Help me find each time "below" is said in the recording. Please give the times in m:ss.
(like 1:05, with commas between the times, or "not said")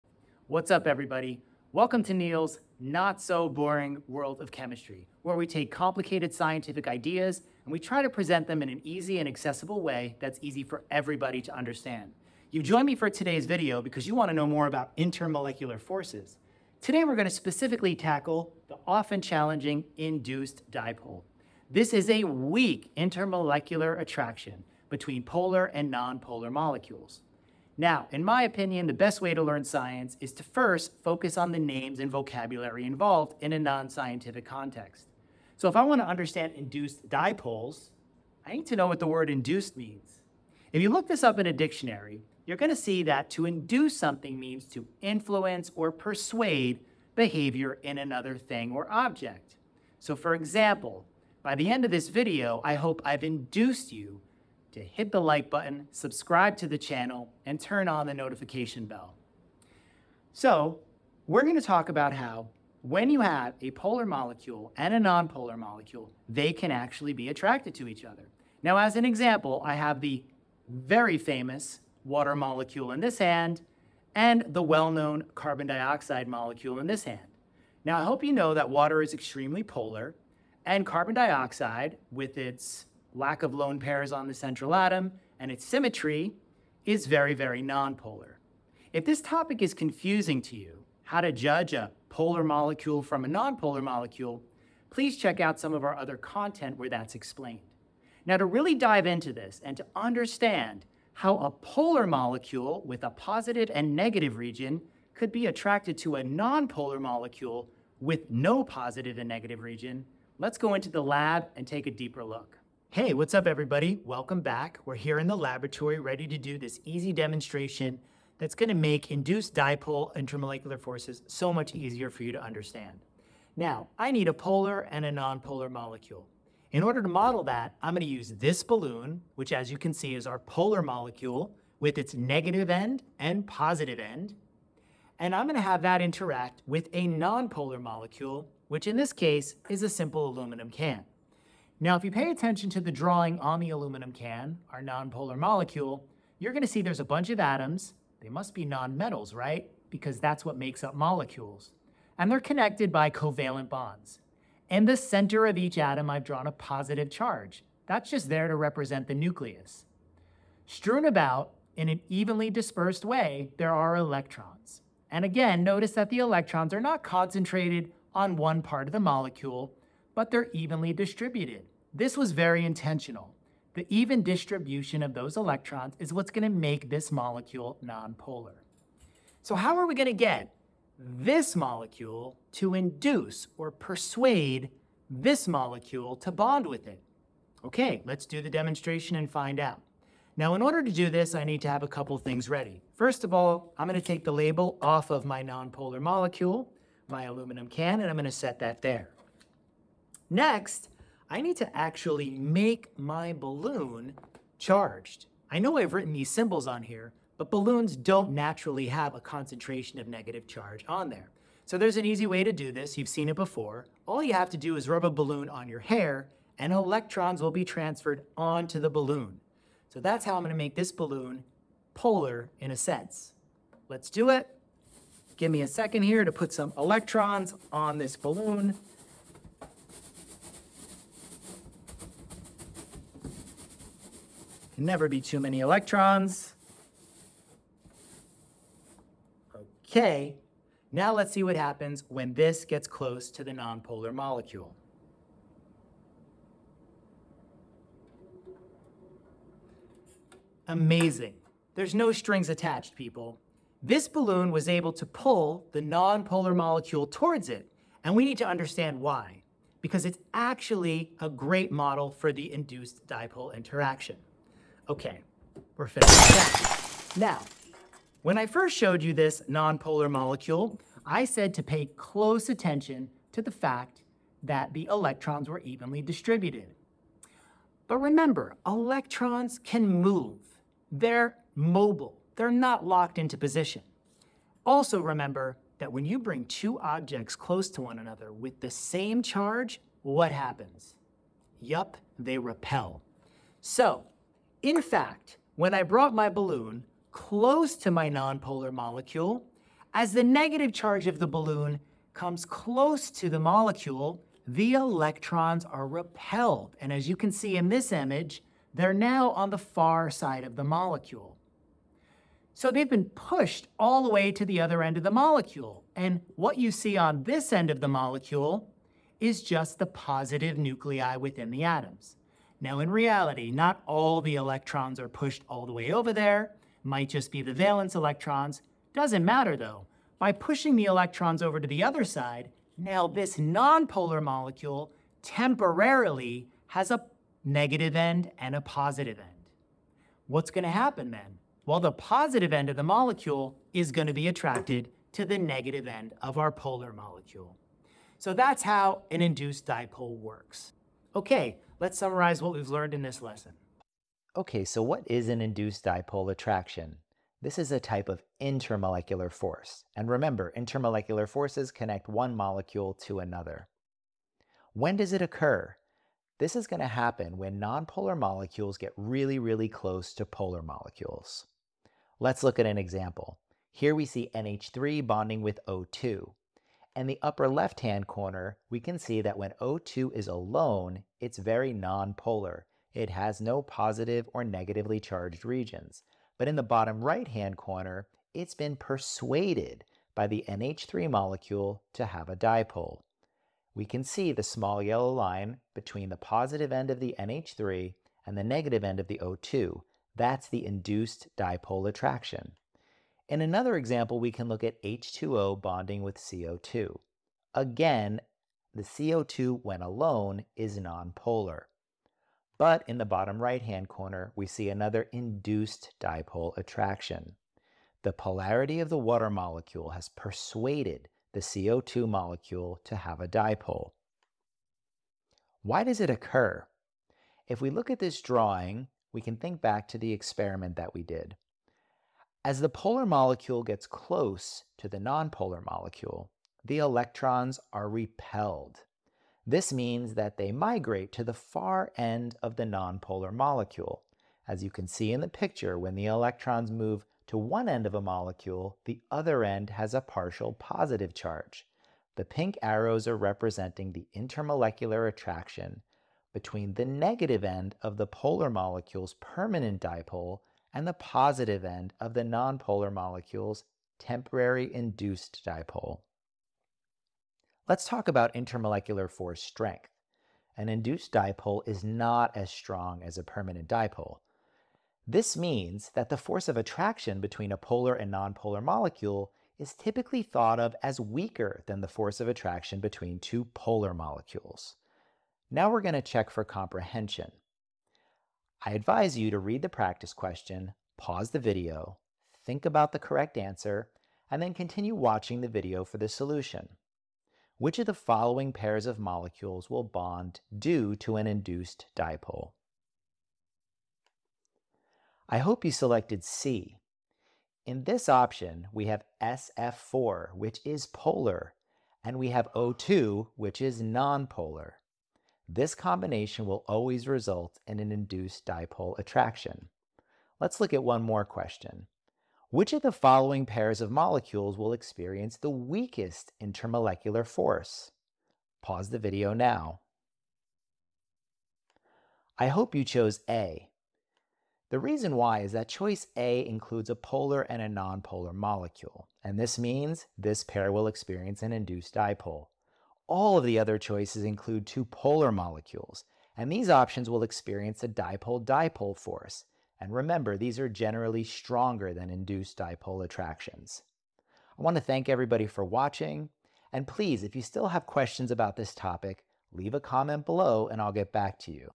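9:20.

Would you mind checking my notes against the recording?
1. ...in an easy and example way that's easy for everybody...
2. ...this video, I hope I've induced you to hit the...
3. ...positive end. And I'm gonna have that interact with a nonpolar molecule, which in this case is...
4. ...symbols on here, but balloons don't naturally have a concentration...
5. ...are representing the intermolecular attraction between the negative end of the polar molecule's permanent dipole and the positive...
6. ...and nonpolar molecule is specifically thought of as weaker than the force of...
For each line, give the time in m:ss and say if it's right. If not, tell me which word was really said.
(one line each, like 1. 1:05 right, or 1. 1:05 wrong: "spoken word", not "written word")
1. 0:08 wrong: "accessible", not "example"
2. 0:51 right
3. 2:13 right
4. 3:26 right
5. 7:33 right
6. 7:57 wrong: "typically", not "specifically".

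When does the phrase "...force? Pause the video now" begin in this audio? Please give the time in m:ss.
8:47.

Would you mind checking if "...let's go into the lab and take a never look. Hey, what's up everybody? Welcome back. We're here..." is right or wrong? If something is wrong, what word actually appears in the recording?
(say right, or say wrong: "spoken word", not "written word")
wrong: "deeper", not "never".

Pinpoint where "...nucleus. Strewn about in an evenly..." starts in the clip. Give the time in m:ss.
2:39.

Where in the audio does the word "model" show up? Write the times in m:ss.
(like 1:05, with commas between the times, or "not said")
2:07, 4:21.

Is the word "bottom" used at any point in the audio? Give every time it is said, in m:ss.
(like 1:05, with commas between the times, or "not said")
6:26, 6:53.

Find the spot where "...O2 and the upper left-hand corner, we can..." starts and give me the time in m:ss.
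6:15.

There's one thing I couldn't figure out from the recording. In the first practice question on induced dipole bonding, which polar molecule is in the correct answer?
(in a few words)
SF4.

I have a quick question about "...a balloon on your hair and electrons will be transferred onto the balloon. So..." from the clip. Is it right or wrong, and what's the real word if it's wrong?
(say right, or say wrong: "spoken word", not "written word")
right.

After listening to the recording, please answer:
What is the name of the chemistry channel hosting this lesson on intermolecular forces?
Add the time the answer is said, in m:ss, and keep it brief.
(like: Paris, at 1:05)
Neil's not so Bohring world of chemistry, at 0:02.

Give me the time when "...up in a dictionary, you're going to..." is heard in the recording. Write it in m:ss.
0:41.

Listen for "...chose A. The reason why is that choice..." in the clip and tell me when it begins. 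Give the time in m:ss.
8:52.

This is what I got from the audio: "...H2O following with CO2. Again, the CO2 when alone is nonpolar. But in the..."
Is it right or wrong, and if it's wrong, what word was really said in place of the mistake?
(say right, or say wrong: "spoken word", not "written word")
wrong: "bonding", not "following".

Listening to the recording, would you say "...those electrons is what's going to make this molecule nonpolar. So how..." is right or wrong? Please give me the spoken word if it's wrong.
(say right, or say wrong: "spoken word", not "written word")
right.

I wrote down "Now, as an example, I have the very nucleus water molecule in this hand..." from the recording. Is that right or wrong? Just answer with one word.
wrong.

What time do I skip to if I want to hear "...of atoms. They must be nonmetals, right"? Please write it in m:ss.
2:27.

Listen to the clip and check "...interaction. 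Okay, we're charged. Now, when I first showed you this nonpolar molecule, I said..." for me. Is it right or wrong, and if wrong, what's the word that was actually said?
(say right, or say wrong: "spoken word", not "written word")
wrong: "finished", not "charged".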